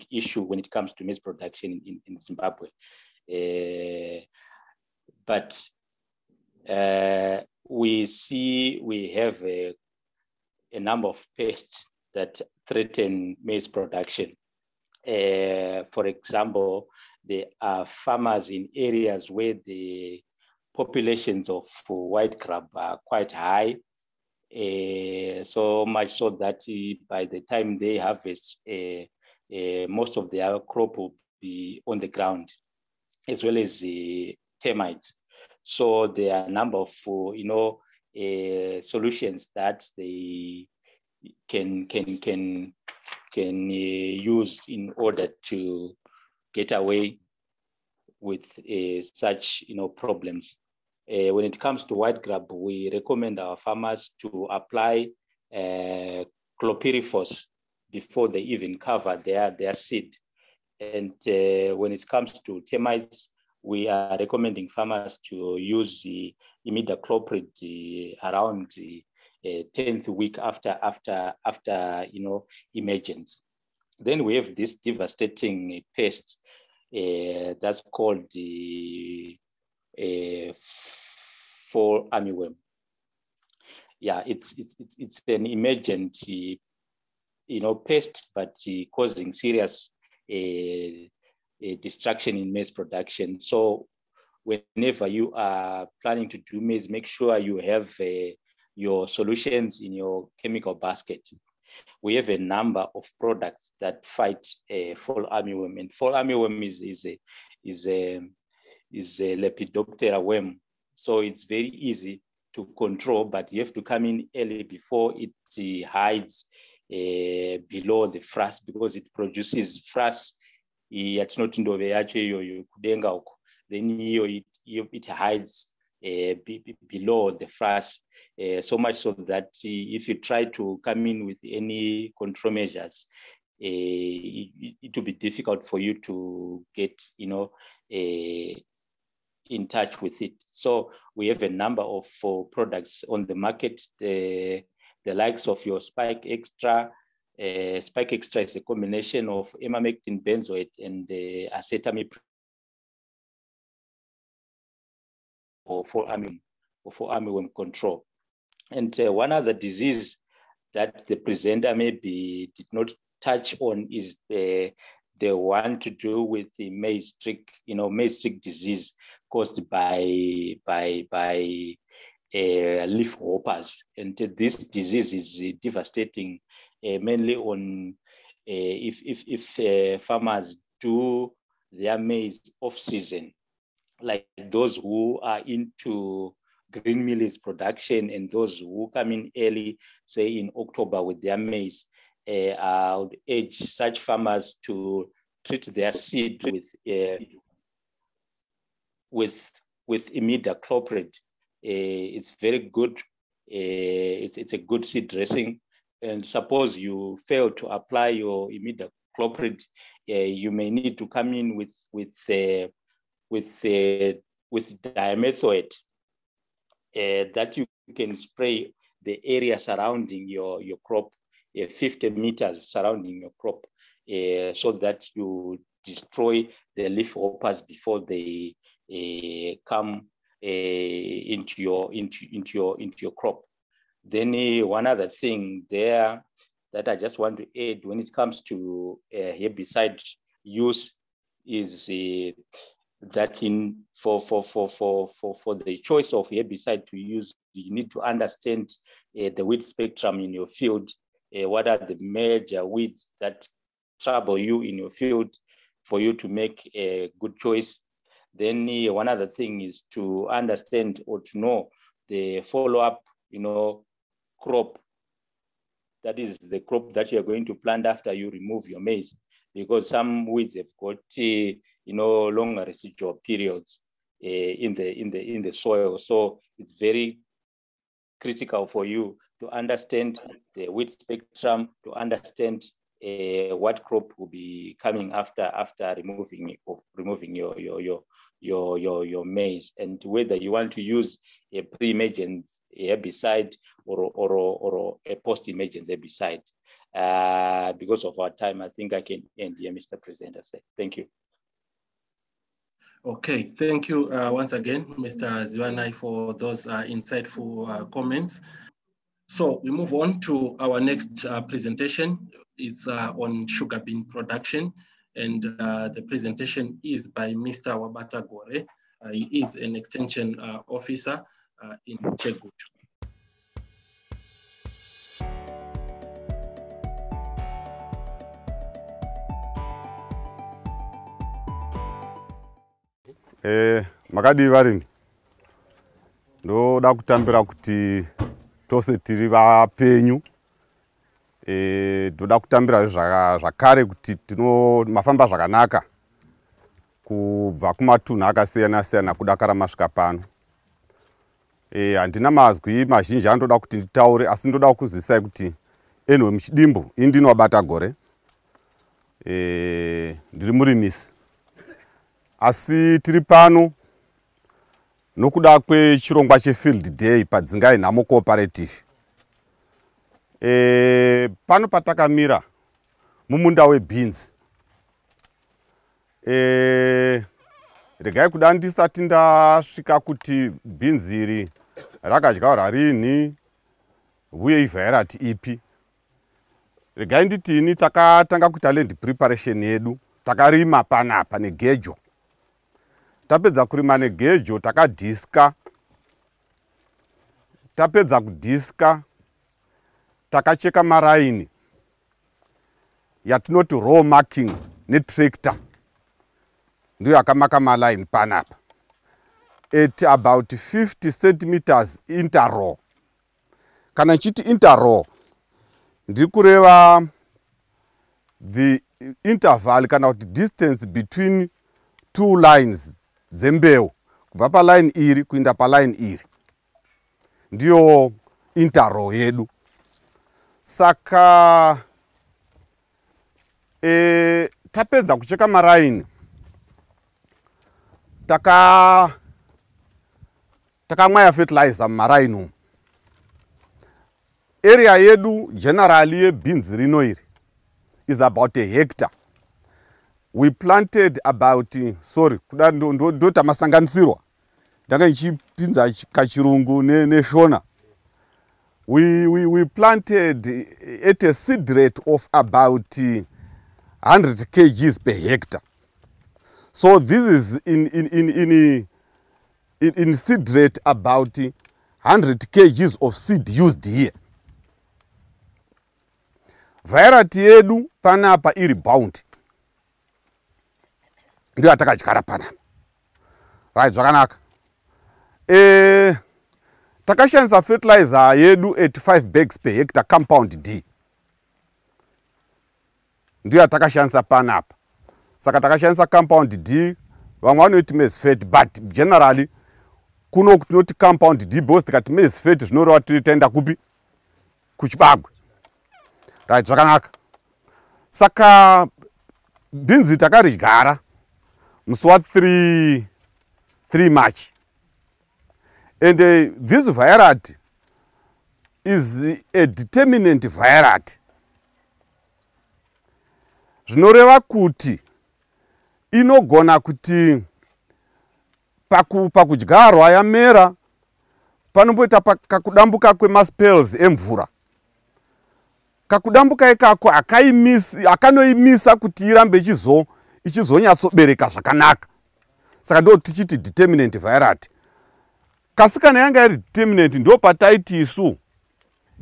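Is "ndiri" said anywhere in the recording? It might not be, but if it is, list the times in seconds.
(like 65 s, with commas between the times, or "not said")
360 s, 416 s.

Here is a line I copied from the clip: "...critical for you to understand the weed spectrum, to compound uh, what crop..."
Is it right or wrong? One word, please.
wrong.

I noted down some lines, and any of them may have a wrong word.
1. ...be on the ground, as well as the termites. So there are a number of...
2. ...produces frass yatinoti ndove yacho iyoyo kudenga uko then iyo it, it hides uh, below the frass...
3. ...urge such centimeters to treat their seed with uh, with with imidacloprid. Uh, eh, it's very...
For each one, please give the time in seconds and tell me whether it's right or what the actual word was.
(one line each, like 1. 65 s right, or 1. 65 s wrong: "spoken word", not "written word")
1. 31 s right
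2. 119 s right
3. 193 s wrong: "farmers", not "centimeters".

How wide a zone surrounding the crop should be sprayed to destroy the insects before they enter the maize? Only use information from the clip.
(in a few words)
50 meters.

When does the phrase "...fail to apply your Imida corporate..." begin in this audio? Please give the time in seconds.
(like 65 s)
207 s.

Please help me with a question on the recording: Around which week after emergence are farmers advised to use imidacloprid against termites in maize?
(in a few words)
10th week.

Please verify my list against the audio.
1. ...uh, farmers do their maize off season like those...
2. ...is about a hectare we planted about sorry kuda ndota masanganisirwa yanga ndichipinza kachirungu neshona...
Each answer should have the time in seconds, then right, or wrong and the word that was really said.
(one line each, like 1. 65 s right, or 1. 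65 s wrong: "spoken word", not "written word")
1. 179 s right
2. 448 s wrong: "ndanga", not "yanga".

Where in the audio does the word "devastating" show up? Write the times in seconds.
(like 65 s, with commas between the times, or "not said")
74 s, 175 s.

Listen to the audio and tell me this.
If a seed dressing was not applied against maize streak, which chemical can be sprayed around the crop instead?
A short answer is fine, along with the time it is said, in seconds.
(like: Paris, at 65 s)
dimethoate, at 214 s.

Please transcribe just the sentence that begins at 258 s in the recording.
Then uh, one other thing is to understand or to know the follow-up, you know, crop.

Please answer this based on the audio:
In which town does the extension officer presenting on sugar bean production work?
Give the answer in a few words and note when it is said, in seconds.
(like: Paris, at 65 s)
Chegutu, at 322 s.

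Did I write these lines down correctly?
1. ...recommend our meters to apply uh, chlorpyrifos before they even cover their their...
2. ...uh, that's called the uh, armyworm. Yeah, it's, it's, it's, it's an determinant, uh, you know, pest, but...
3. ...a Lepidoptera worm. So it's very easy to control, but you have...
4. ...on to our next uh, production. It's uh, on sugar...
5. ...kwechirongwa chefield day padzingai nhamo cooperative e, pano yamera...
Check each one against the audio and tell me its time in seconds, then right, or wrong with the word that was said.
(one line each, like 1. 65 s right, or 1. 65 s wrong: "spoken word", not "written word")
1. 52 s wrong: "farmers", not "meters"
2. 76 s wrong: "emergent", not "determinant"
3. 109 s right
4. 309 s wrong: "presentation", not "production"
5. 365 s wrong: "patakamira", not "yamera".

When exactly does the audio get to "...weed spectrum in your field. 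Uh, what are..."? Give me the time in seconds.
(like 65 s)
249 s.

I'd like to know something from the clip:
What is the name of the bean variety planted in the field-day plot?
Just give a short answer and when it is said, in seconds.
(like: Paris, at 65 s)
Bounty, at 478 s.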